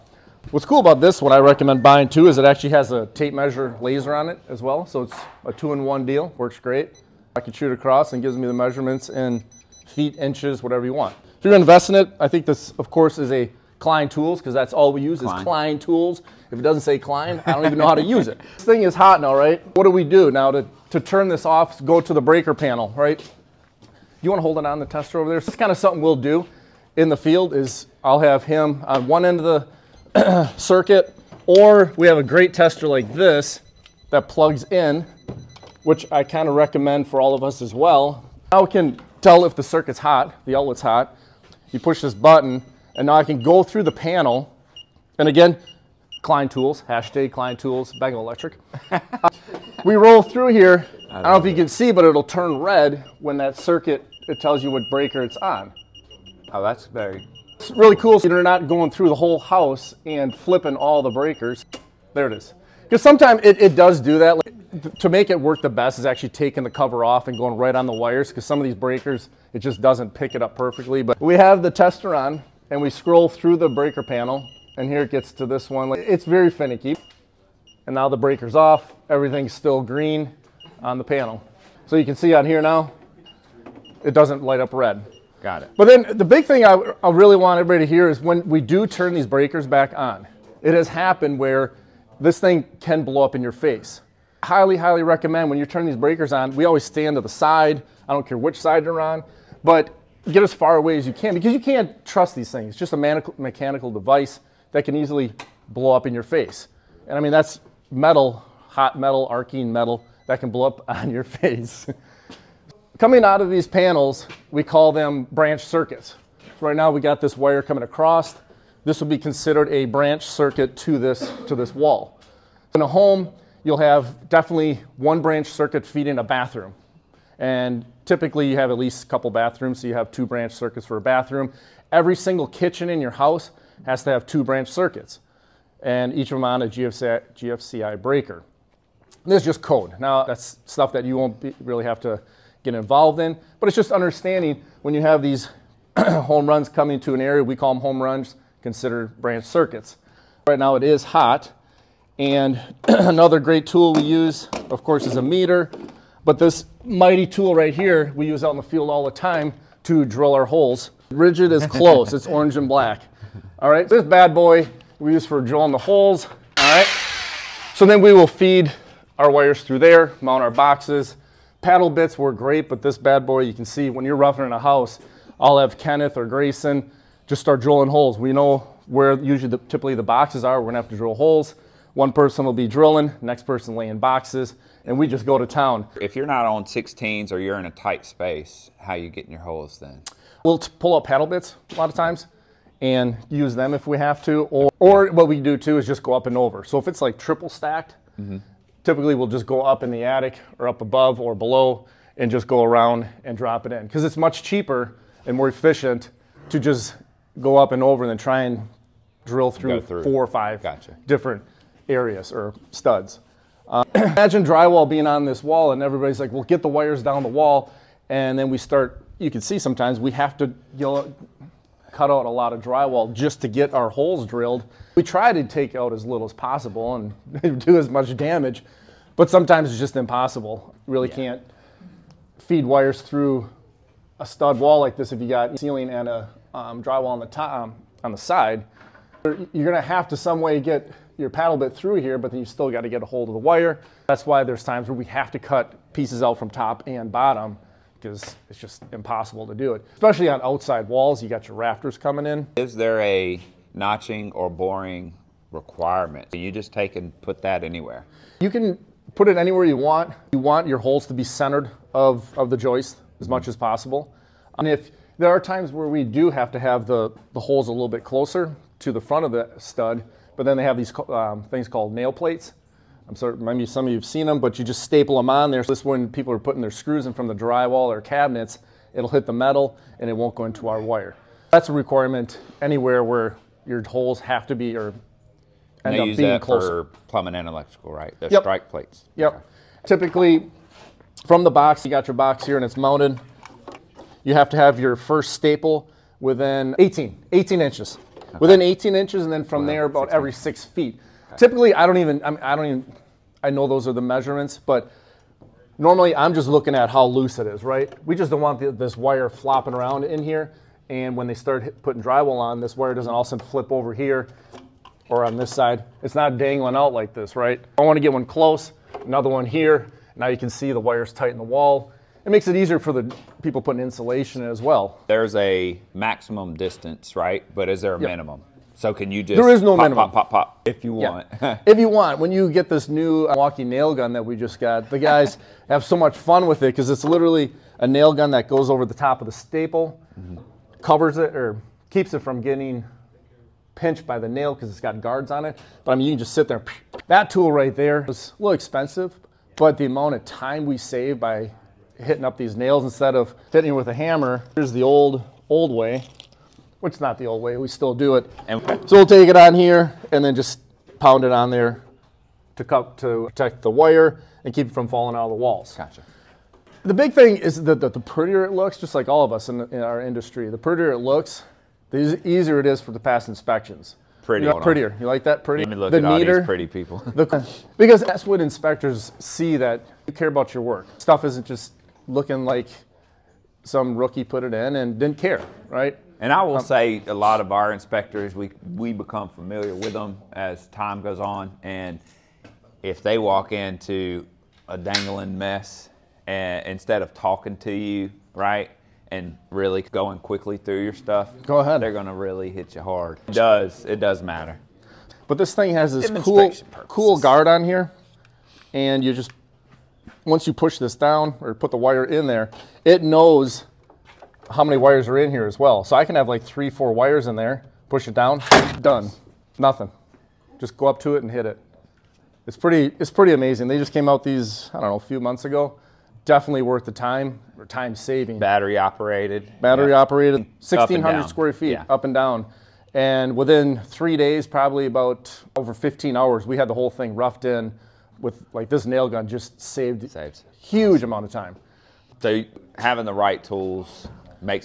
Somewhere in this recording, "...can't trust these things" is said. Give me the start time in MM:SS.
01:41.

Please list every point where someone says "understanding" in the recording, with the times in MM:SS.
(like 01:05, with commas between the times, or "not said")
02:23.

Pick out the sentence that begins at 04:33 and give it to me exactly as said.
maybe some of you have seen them, but you just staple them on there.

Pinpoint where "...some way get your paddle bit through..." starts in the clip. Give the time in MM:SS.
04:00.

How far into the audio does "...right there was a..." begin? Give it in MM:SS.
05:47.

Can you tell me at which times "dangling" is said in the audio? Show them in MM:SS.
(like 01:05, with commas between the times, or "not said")
05:16, 06:34.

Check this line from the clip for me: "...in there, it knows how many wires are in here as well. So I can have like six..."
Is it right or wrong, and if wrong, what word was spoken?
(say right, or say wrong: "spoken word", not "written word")
wrong: "three", not "six".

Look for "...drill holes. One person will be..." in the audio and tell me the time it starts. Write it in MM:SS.
03:00.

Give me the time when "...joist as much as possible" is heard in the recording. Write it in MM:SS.
04:22.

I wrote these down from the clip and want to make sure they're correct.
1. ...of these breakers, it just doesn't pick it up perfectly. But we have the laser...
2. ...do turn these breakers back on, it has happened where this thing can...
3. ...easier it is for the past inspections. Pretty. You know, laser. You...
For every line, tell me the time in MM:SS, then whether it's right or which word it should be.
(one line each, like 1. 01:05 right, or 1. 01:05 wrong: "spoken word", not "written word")
1. 01:08 wrong: "tester", not "laser"
2. 01:28 right
3. 06:12 wrong: "prettier", not "laser".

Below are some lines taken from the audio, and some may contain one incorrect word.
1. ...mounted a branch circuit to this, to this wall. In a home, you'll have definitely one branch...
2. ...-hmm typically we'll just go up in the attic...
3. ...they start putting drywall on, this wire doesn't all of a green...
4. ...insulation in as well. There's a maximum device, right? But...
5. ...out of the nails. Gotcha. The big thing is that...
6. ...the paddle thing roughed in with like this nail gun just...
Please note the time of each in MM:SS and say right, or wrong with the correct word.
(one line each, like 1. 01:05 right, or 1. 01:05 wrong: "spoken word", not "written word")
1. 01:59 wrong: "considered", not "mounted"
2. 03:18 right
3. 05:11 wrong: "sudden", not "green"
4. 05:23 wrong: "distance", not "device"
5. 06:05 wrong: "walls", not "nails"
6. 07:16 wrong: "whole", not "paddle".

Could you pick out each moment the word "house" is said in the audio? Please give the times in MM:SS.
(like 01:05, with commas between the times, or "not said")
00:59, 02:13, 02:54.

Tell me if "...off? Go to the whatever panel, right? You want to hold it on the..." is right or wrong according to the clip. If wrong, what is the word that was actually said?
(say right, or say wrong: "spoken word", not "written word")
wrong: "breaker", not "whatever".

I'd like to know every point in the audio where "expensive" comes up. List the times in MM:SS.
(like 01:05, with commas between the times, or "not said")
05:48.